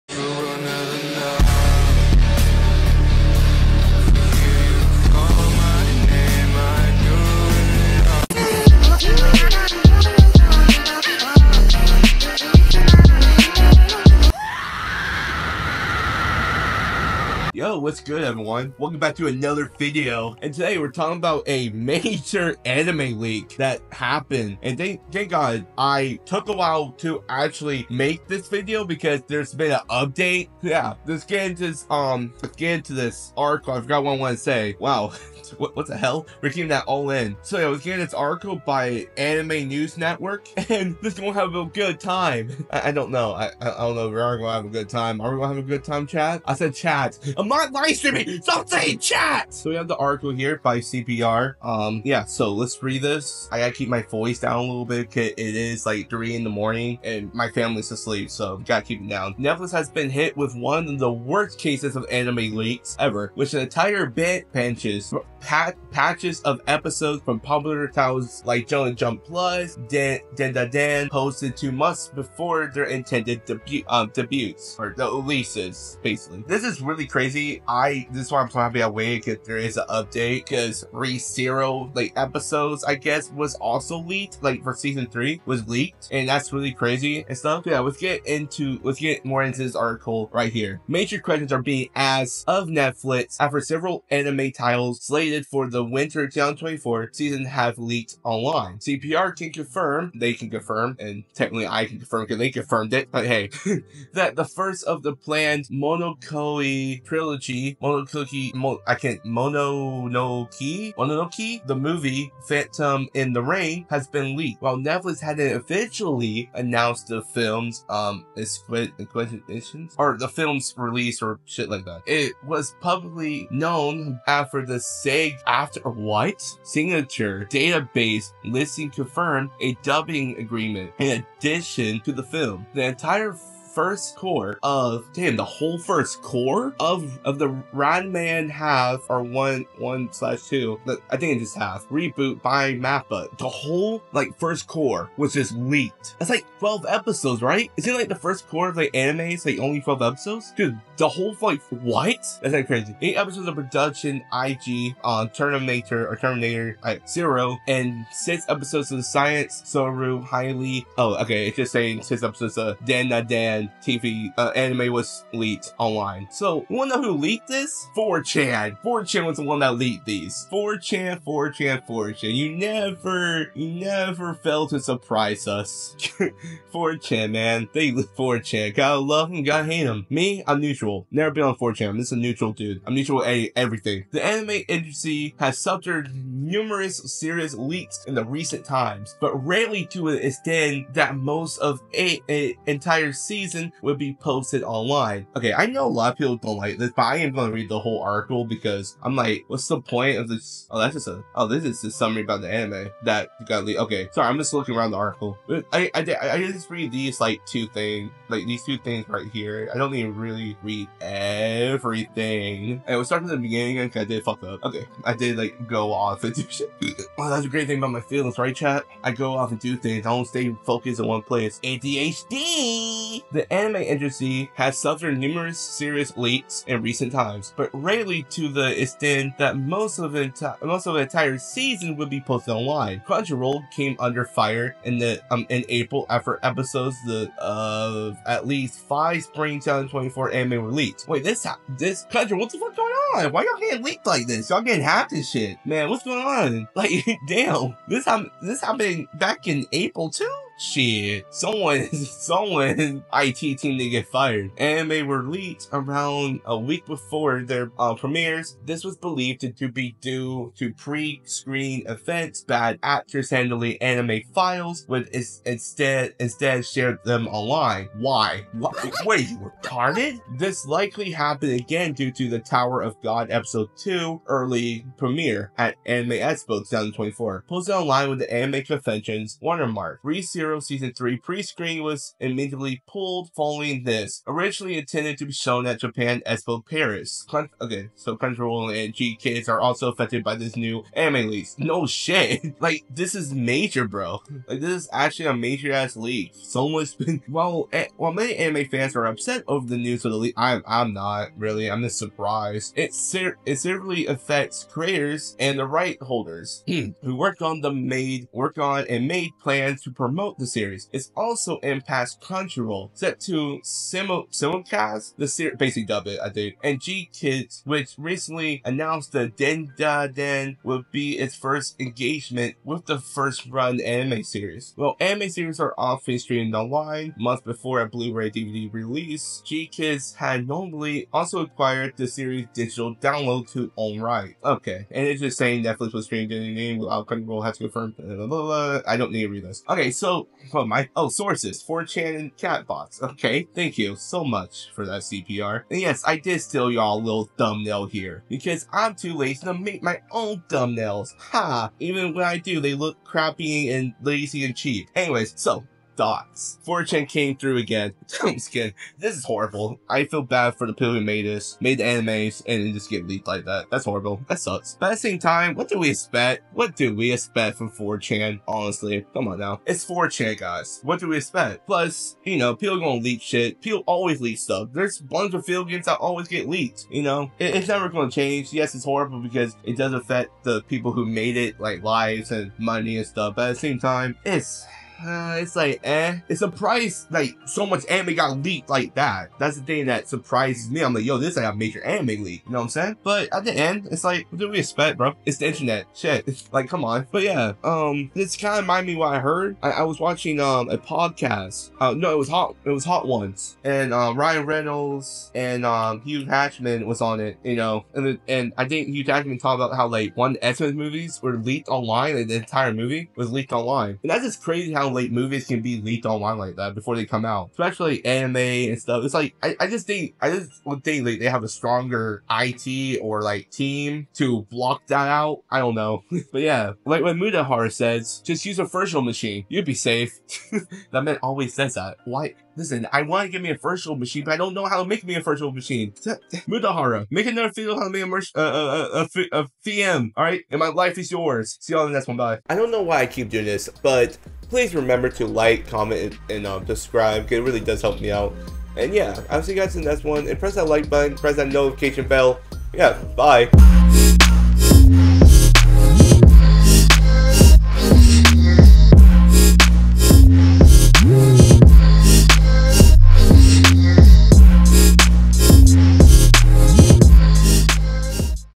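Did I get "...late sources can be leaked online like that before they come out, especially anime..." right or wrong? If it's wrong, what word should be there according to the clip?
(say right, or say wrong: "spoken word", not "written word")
wrong: "movies", not "sources".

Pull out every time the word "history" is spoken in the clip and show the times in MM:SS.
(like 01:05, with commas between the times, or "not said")
not said.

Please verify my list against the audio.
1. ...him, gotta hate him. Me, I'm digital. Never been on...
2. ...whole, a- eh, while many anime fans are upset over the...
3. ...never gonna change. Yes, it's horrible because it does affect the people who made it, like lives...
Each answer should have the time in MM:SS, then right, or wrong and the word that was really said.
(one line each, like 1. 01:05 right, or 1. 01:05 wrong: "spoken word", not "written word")
1. 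02:59 wrong: "neutral", not "digital"
2. 04:57 wrong: "while", not "whole"
3. 06:17 right.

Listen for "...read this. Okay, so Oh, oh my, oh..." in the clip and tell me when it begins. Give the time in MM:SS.
05:39.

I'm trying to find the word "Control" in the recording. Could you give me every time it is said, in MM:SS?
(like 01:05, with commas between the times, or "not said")
04:48.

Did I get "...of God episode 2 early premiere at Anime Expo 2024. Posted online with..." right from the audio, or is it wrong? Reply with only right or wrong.
right.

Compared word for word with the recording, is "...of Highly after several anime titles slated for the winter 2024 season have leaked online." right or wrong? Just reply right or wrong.
wrong.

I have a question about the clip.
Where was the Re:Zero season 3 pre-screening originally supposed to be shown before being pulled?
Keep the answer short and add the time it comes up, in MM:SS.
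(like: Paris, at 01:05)
Japan Expo Paris, at 04:45.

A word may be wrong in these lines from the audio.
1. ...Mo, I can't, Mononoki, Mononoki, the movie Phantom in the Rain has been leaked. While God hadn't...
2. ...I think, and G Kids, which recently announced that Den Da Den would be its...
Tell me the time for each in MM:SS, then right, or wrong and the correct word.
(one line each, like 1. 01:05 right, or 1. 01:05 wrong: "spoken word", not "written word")
1. 01:48 wrong: "Netflix", not "God"
2. 05:16 right.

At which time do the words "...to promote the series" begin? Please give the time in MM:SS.
05:09.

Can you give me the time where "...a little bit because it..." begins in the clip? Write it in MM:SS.
00:54.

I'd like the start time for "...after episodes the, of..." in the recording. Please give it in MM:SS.
03:56.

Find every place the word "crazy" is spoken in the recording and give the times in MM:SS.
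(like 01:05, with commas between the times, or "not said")
01:17, 01:26, 02:32, 06:54.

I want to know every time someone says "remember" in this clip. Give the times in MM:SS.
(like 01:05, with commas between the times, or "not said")
07:24.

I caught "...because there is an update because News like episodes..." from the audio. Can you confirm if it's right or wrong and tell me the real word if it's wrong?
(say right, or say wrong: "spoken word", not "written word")
wrong: "ReZero", not "News".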